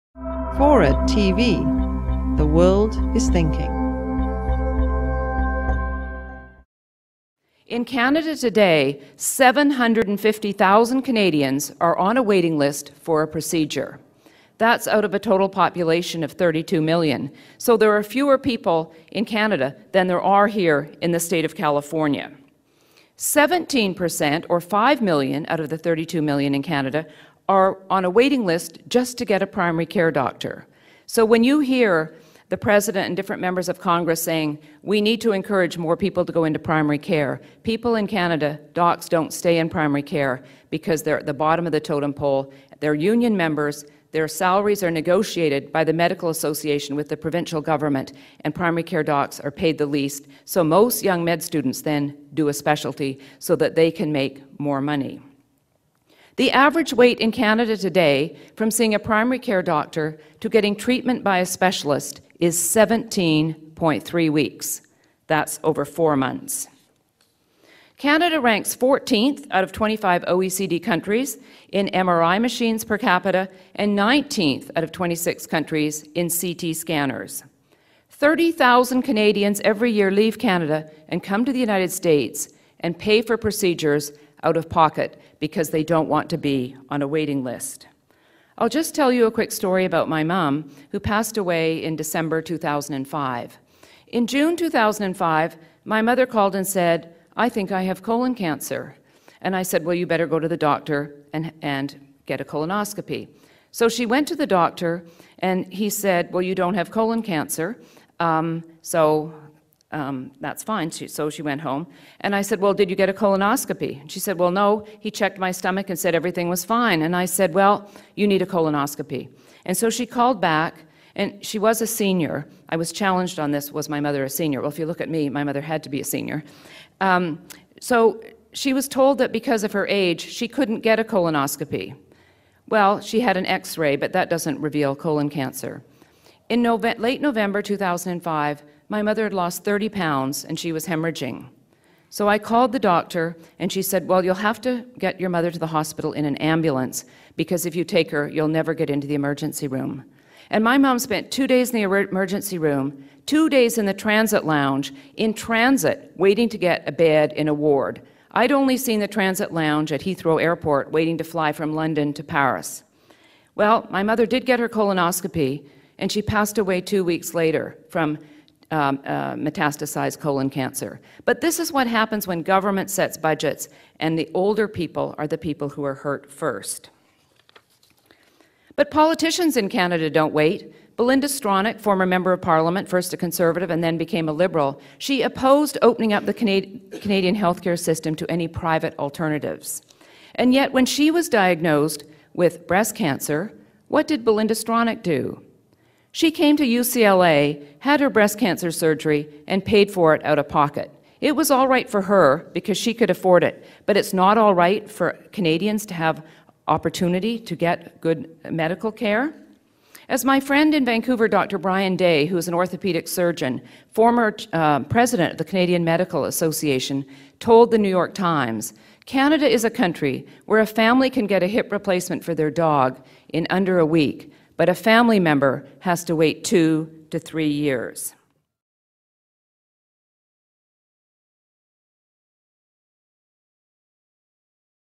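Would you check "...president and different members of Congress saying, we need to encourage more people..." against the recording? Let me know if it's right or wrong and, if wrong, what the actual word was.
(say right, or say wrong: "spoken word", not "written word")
right.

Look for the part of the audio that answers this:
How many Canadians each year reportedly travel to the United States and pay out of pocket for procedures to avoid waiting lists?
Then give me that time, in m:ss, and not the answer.
1:18.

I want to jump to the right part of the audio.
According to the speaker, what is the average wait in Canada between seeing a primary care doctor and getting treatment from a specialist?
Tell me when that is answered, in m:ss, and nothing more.
1:02.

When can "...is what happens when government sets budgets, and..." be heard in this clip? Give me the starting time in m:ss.
2:51.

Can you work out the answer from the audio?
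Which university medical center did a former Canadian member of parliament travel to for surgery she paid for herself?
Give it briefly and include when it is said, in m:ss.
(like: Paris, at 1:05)
UCLA, at 3:16.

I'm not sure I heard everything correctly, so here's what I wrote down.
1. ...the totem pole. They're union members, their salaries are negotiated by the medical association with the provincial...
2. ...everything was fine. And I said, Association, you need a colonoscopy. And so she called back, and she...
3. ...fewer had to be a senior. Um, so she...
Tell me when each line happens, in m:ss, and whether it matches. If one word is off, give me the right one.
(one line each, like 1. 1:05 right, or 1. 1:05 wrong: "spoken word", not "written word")
1. 0:41 right
2. 1:56 wrong: "Well", not "Association"
3. 2:05 wrong: "mother", not "fewer".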